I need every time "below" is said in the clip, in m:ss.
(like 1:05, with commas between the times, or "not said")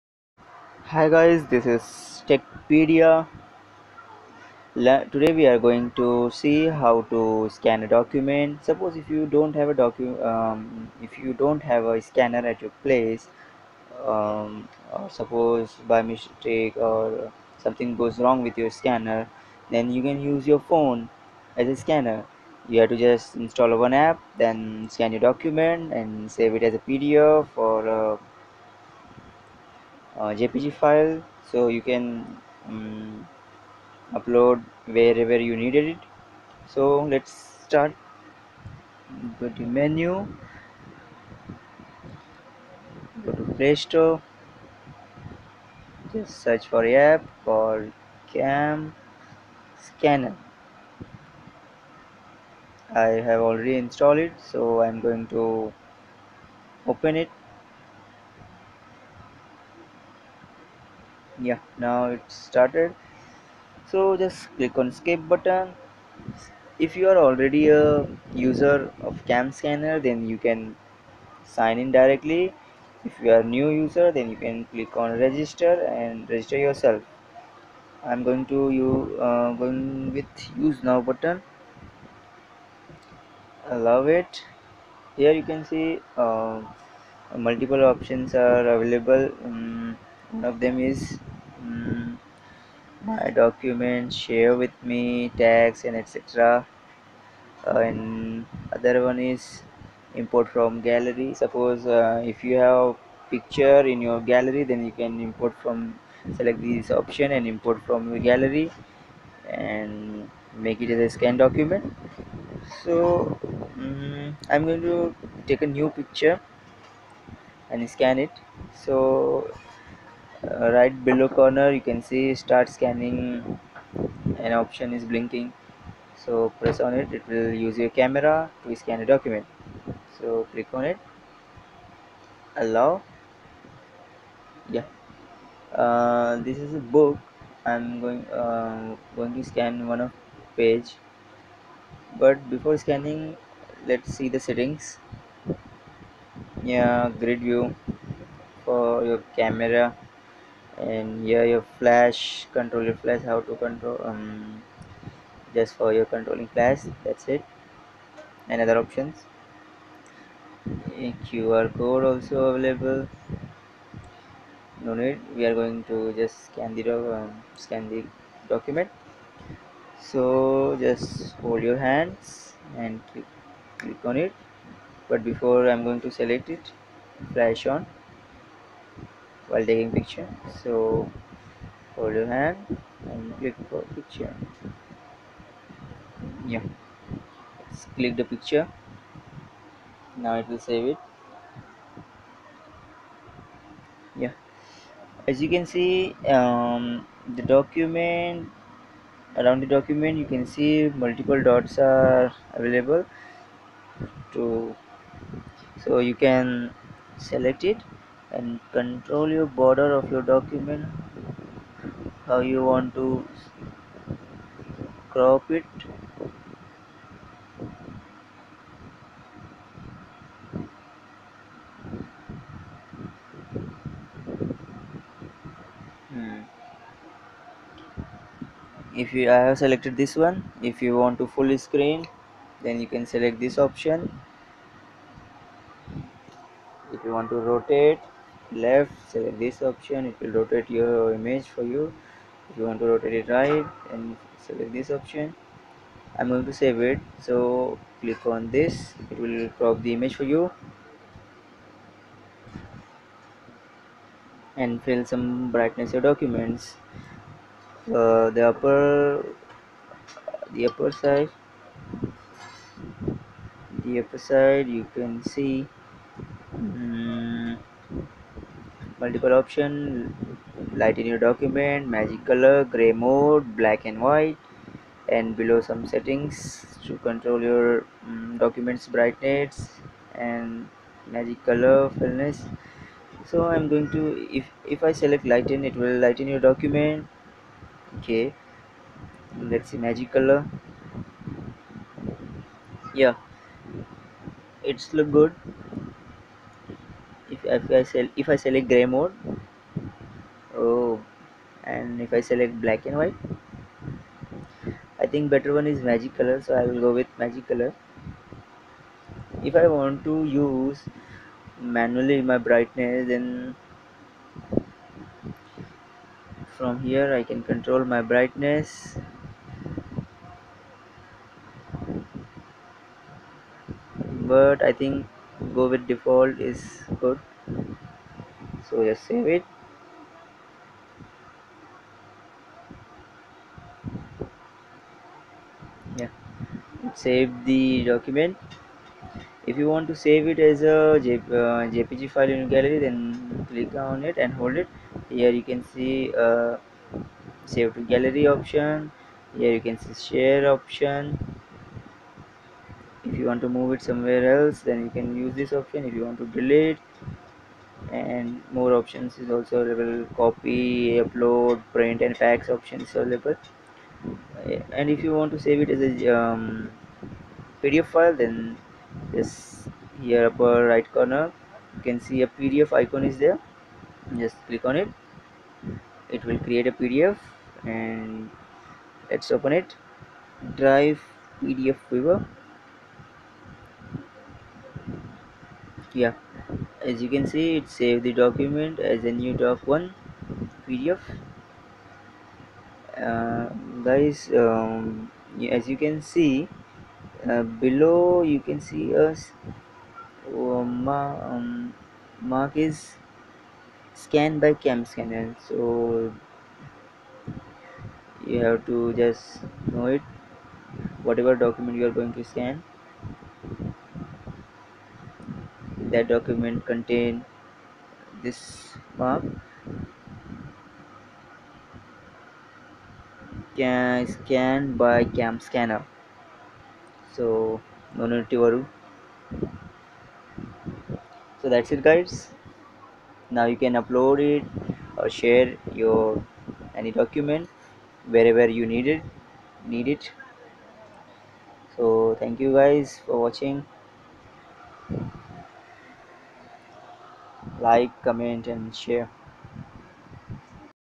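2:01, 4:35, 6:37.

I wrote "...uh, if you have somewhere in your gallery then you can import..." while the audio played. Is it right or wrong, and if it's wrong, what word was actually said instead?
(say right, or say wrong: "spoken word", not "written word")
wrong: "picture", not "somewhere".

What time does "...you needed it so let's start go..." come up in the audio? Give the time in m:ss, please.
0:35.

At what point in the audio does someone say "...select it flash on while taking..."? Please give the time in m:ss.
2:56.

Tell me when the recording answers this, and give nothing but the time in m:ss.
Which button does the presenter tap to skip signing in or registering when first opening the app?
1:20.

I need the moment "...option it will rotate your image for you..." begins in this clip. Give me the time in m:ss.
3:59.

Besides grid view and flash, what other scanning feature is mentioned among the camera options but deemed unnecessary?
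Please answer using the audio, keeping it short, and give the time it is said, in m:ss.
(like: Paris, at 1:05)
QR code, at 2:41.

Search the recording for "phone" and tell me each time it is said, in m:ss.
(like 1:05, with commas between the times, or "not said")
0:20.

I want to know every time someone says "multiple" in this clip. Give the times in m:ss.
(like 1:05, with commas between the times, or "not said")
1:27, 3:21, 4:29.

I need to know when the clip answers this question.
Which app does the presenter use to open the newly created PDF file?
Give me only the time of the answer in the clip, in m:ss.
6:20.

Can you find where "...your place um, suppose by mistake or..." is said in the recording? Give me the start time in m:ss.
0:12.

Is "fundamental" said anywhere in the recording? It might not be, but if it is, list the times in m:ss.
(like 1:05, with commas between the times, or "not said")
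not said.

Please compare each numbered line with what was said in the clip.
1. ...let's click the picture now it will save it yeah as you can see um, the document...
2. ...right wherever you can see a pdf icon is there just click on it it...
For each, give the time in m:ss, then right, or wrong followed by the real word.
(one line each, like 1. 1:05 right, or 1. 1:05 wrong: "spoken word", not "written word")
1. 3:07 right
2. 6:10 wrong: "corner", not "wherever".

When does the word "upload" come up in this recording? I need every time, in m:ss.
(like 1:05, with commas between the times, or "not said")
0:34, 6:01, 7:13.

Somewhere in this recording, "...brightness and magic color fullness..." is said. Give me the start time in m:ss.
4:38.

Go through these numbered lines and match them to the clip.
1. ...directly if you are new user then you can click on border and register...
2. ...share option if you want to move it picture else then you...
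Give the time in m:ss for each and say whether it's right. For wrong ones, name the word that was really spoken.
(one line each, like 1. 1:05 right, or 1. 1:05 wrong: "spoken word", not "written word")
1. 1:11 wrong: "register", not "border"
2. 5:50 wrong: "somewhere", not "picture".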